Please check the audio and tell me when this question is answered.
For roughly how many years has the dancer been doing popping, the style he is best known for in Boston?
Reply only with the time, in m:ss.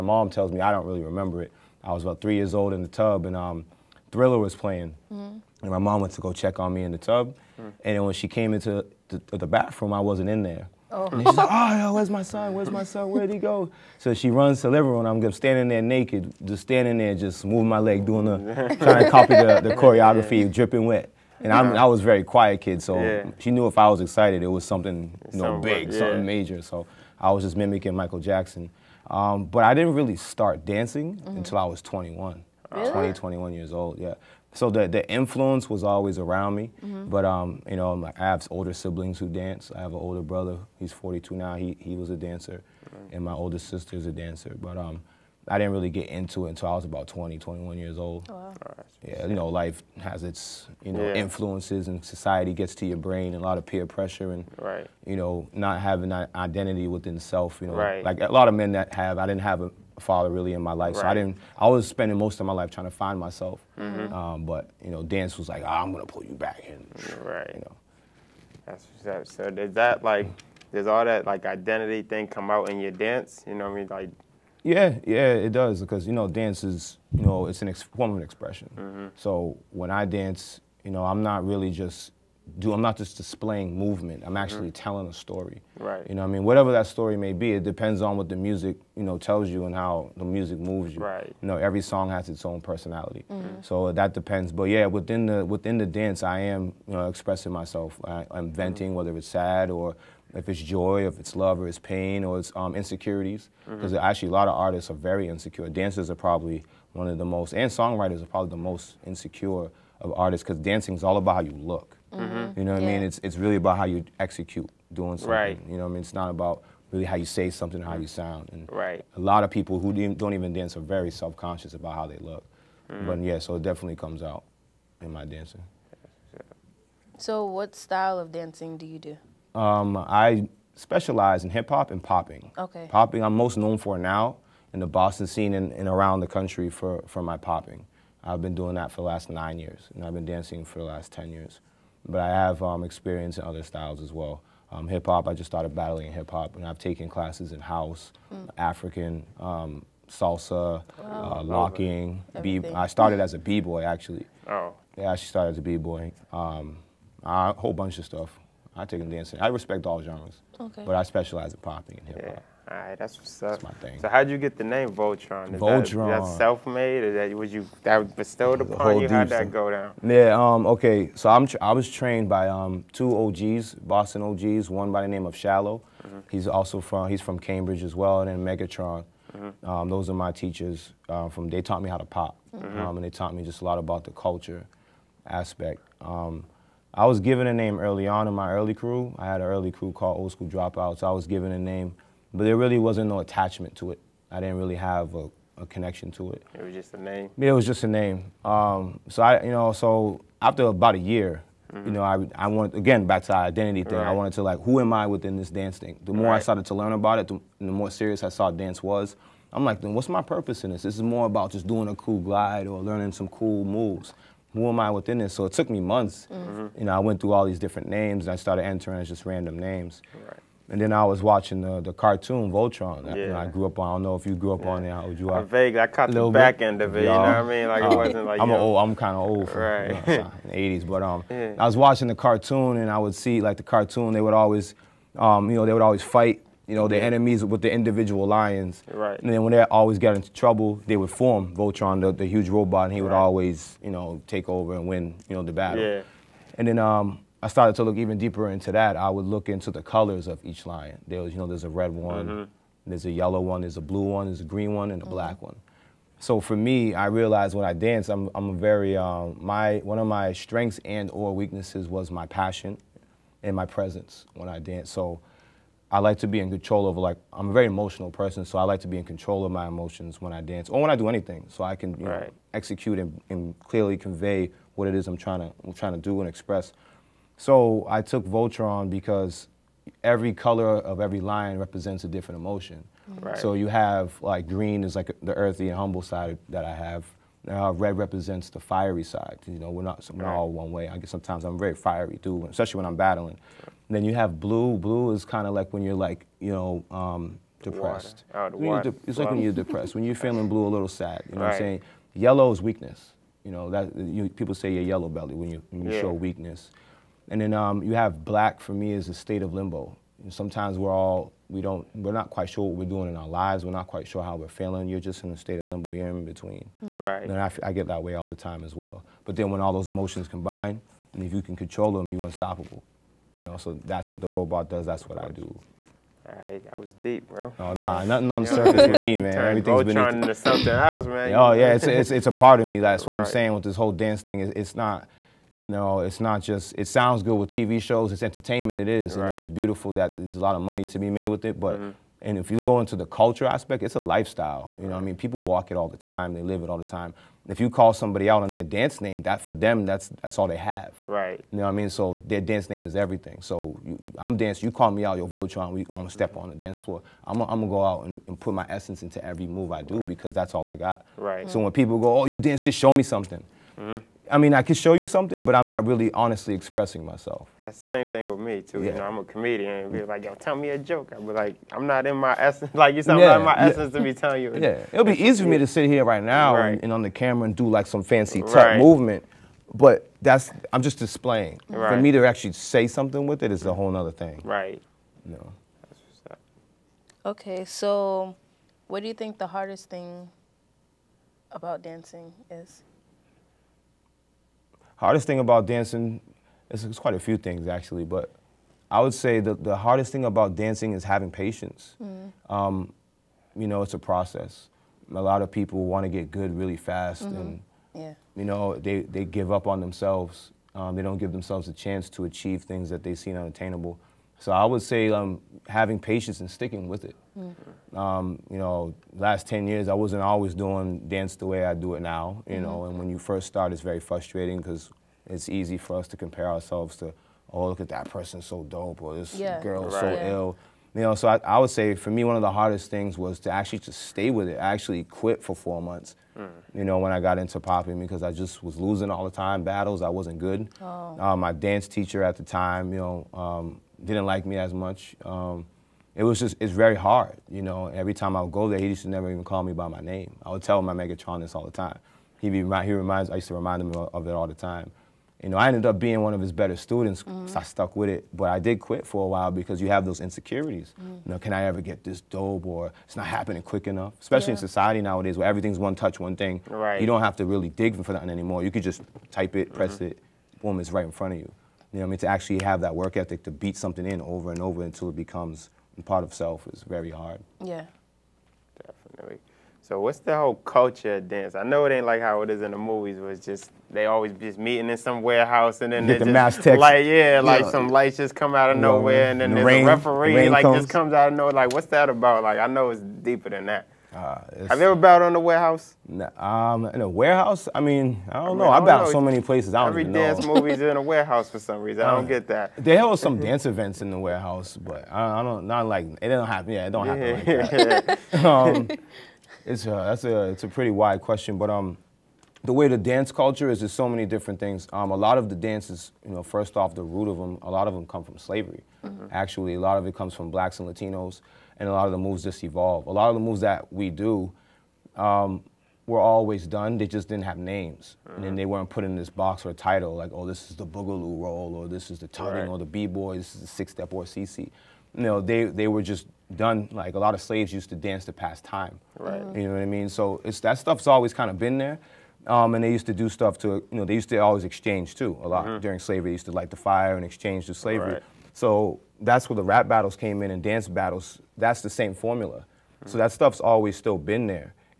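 2:19.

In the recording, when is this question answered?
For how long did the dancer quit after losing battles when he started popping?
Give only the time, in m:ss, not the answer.
7:15.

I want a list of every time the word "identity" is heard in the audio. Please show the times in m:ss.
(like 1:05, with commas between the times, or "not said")
0:56, 1:11, 3:23.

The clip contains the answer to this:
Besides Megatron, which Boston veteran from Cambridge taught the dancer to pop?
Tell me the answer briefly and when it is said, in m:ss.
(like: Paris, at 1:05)
Shallow, at 2:55.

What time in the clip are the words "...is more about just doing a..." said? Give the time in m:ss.
3:30.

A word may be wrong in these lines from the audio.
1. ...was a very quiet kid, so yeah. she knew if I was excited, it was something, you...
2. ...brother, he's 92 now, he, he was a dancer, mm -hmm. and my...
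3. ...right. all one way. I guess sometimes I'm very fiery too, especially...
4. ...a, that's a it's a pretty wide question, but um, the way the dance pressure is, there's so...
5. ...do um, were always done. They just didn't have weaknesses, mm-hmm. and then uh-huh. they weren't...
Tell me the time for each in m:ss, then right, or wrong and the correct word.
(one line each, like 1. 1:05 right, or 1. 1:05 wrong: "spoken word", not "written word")
1. 0:21 right
2. 0:40 wrong: "42", not "92"
3. 4:50 right
4. 8:29 wrong: "culture", not "pressure"
5. 8:44 wrong: "names", not "weaknesses".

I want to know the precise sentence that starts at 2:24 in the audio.
Um, hip hop, I just started battling hip hop, and I've taken classes in house, mm.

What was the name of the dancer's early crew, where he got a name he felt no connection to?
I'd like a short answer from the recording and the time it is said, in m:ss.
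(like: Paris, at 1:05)
Old School Dropouts, at 3:10.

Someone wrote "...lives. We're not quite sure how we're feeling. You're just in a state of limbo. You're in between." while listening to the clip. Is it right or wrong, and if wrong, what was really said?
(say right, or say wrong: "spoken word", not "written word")
right.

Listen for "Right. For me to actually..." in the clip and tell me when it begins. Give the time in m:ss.
6:21.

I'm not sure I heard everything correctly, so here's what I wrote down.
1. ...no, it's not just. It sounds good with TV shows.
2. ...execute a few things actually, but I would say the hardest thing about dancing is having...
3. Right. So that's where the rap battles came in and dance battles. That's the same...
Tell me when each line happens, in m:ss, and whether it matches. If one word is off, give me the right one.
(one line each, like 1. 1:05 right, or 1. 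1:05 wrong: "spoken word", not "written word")
1. 5:35 right
2. 6:36 wrong: "quite", not "execute"
3. 9:08 right.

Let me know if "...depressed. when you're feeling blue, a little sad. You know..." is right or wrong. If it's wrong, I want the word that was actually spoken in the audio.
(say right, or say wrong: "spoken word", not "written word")
right.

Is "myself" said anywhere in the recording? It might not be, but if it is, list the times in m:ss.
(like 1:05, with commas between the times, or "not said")
1:03, 1:37, 6:07.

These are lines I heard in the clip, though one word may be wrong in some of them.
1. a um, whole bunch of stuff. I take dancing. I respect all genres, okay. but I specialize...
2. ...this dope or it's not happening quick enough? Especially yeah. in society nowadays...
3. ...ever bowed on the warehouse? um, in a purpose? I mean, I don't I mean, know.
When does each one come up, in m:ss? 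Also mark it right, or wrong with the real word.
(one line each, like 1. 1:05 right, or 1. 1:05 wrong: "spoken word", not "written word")
1. 2:36 right
2. 7:42 right
3. 8:14 wrong: "warehouse", not "purpose".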